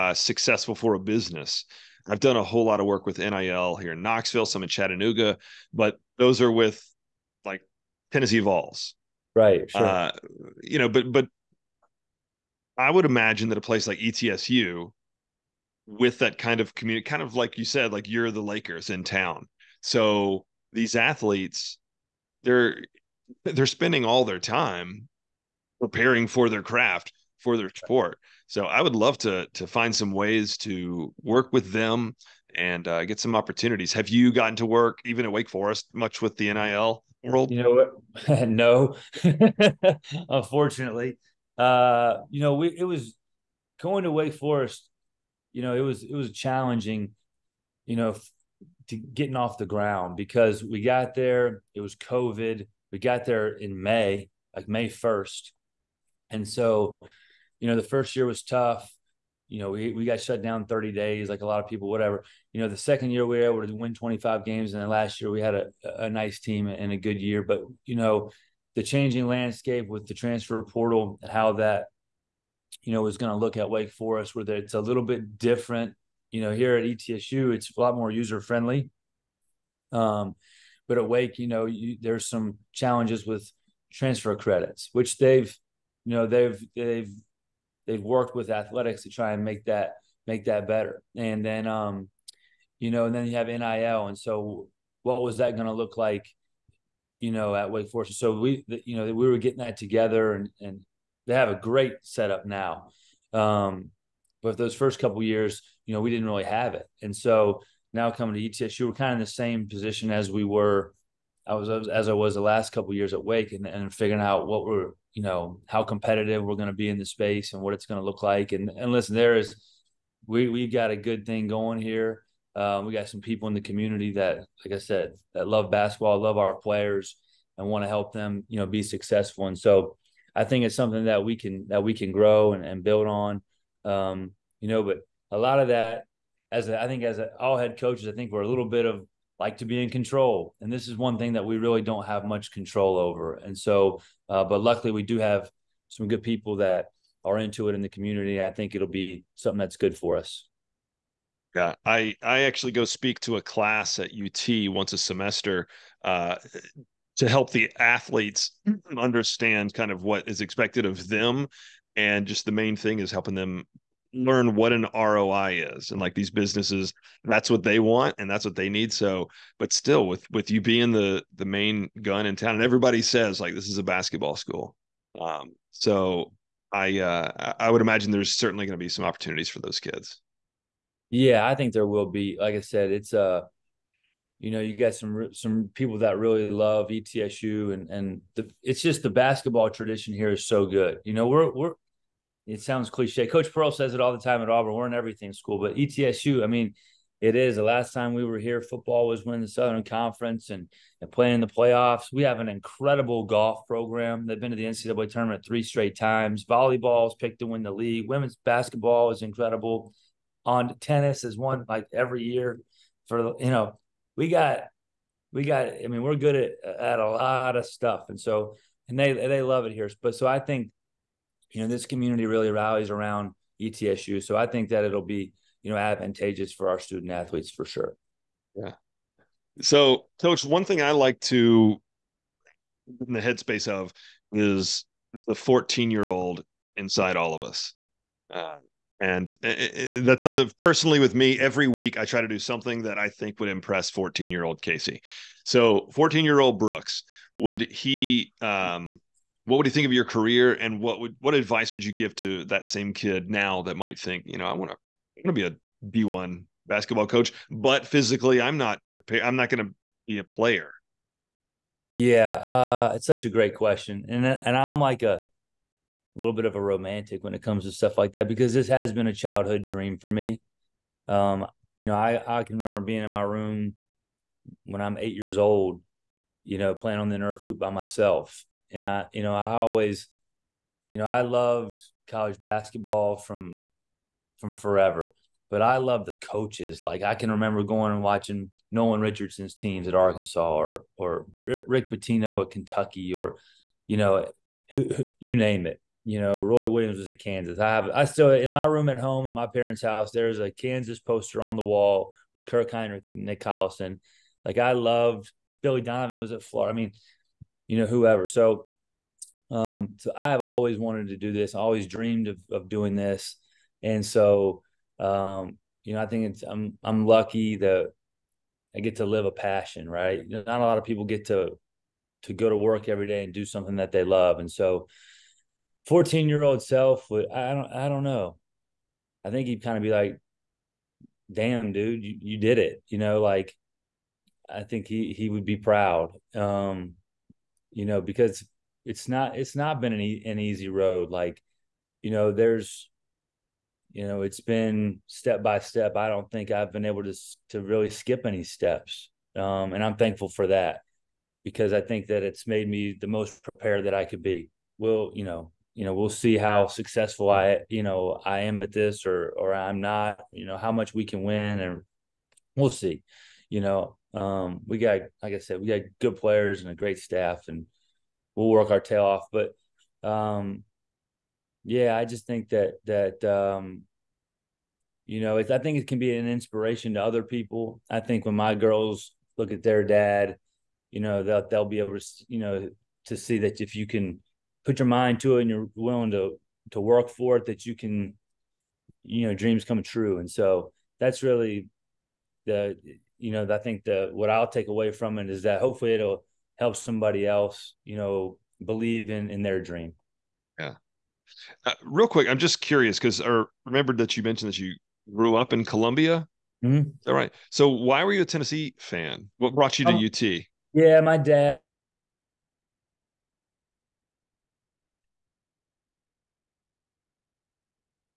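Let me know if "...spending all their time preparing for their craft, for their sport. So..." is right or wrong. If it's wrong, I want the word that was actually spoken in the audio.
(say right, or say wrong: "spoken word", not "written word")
right.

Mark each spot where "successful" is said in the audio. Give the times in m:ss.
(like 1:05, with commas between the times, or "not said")
0:00, 2:08, 5:56.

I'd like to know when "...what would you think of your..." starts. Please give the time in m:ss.
4:09.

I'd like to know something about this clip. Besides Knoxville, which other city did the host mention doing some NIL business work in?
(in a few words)
Chattanooga.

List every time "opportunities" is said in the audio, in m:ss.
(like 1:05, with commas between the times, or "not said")
0:33, 2:59.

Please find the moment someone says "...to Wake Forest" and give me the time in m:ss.
0:44.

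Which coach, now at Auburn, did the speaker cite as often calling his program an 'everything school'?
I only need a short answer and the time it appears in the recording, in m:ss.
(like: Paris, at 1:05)
Coach Pearl, at 3:13.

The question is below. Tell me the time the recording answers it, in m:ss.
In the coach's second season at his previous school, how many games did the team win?
1:03.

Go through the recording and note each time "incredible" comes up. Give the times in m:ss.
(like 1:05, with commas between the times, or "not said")
3:22, 3:29.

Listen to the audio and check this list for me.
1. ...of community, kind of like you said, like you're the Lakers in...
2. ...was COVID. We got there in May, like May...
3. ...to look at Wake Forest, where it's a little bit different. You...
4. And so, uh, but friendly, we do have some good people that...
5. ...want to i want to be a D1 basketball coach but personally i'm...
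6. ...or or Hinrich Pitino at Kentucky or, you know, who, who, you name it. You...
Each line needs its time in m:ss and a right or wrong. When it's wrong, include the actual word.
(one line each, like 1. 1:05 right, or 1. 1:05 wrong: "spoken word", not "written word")
1. 0:16 right
2. 0:51 right
3. 1:13 right
4. 2:23 wrong: "luckily", not "friendly"
5. 4:14 wrong: "physically", not "personally"
6. 4:50 wrong: "Rick", not "Hinrich".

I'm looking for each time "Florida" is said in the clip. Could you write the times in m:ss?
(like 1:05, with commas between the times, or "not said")
5:06.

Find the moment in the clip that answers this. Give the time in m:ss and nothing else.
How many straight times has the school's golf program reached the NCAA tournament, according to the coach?
3:25.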